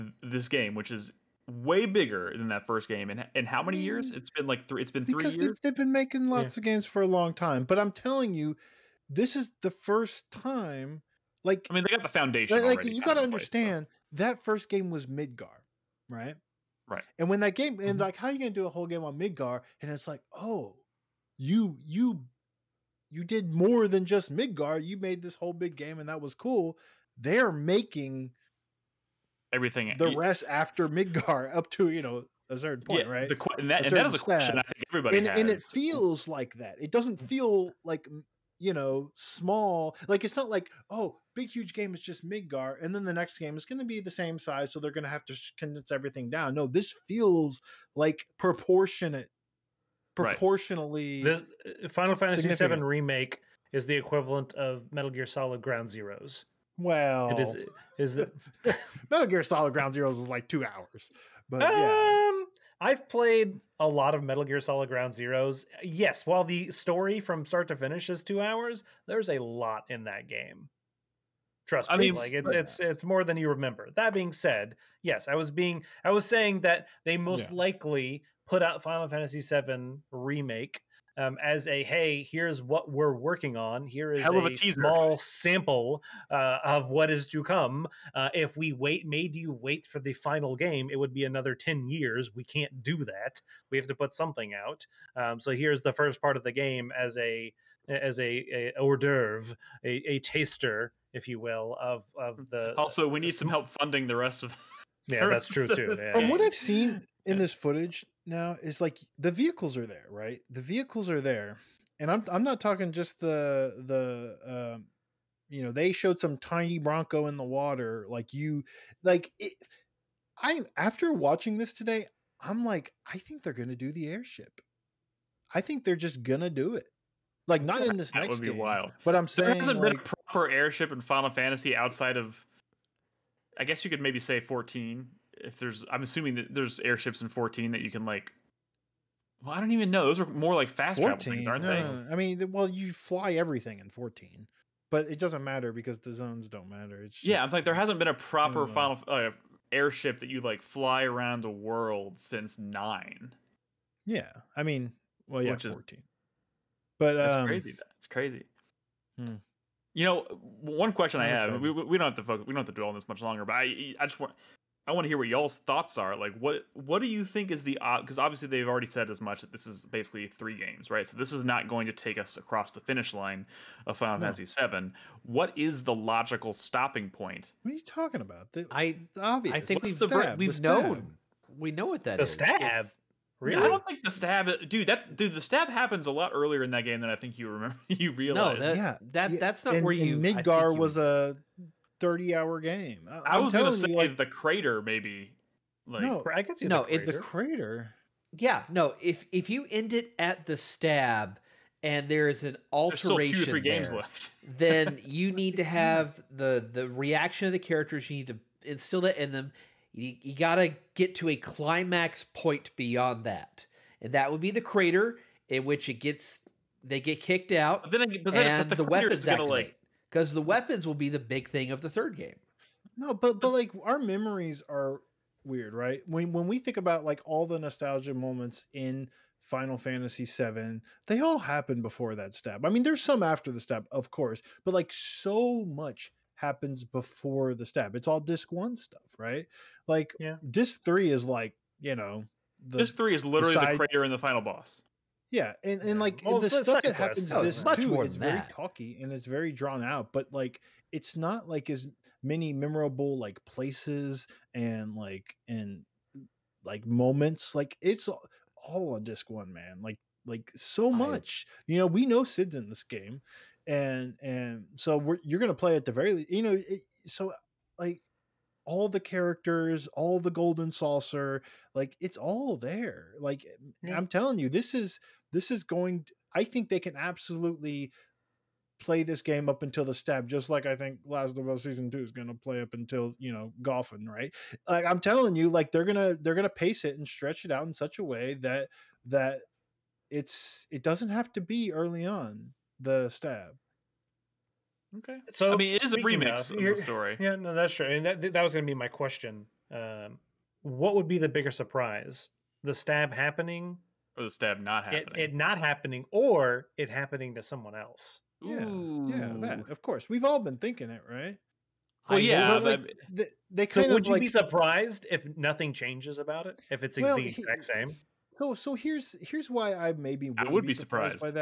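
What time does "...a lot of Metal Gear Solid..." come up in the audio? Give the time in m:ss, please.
1:03.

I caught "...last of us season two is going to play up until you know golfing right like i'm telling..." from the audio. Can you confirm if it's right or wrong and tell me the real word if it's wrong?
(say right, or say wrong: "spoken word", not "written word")
right.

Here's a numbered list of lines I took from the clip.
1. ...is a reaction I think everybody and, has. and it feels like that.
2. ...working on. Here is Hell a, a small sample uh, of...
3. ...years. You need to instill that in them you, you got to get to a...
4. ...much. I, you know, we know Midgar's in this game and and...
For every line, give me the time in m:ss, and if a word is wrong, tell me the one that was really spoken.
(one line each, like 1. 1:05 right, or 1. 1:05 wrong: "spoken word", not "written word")
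1. 0:34 wrong: "question", not "reaction"
2. 1:23 right
3. 3:27 wrong: "characters", not "years"
4. 4:20 wrong: "Cid", not "Midgar".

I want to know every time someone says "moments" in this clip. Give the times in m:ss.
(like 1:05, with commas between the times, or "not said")
3:48, 4:16.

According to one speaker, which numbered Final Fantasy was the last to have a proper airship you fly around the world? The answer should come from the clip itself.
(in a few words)
9.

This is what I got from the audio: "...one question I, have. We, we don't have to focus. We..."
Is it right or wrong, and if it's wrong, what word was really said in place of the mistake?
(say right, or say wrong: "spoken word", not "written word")
right.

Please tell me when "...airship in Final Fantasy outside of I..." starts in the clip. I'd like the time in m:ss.
2:10.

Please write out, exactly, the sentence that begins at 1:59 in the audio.
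It, I after watching this today, I'm like, I think they're gonna do the airship.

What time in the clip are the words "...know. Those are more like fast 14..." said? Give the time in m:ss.
2:19.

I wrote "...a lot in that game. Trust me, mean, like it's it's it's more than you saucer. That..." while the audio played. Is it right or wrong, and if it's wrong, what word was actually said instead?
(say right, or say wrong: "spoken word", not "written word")
wrong: "remember", not "saucer".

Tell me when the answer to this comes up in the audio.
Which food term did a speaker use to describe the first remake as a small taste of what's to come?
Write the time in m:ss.
1:38.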